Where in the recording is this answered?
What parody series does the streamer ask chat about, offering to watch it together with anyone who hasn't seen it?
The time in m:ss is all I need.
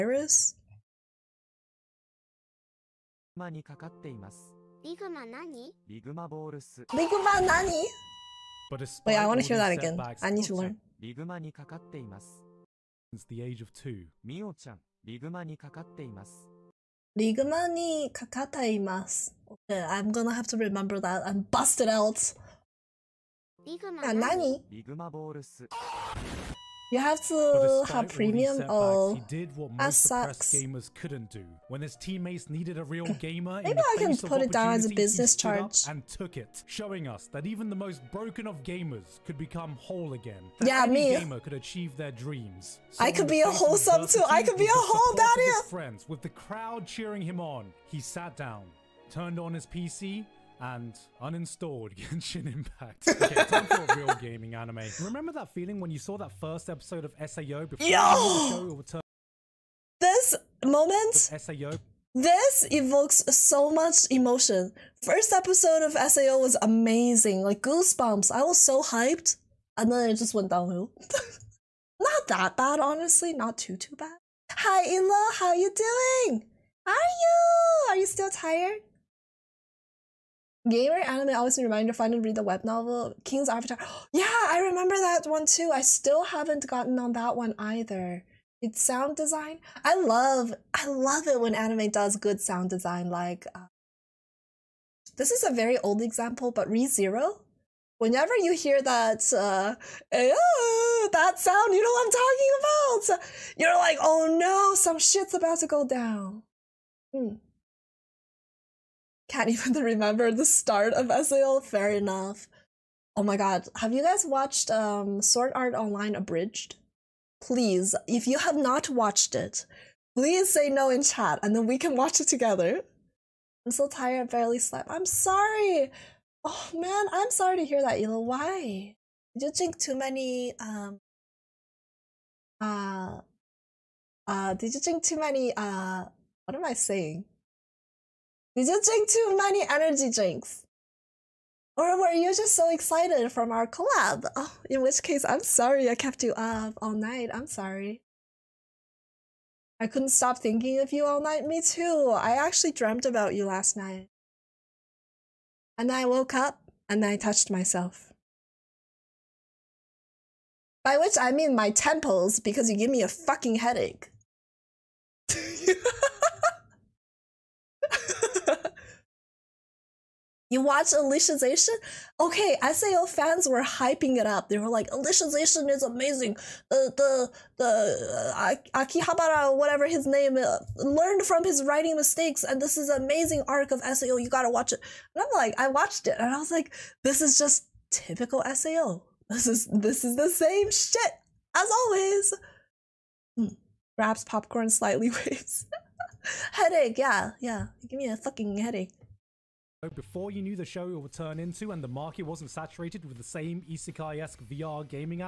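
1:55.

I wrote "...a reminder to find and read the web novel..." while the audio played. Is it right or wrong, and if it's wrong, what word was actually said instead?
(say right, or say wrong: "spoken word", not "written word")
right.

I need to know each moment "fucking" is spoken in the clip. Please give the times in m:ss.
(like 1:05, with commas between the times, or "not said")
2:43, 3:18.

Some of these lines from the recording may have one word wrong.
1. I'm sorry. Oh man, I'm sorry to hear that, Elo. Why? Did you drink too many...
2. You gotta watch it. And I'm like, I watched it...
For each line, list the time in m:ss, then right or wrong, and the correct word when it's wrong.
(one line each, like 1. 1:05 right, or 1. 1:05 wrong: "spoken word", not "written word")
1. 2:04 right
2. 3:04 right.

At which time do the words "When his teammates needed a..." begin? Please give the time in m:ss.
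0:31.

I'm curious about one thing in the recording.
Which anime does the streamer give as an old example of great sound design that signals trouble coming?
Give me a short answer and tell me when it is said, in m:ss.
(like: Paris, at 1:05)
Re:Zero, at 1:36.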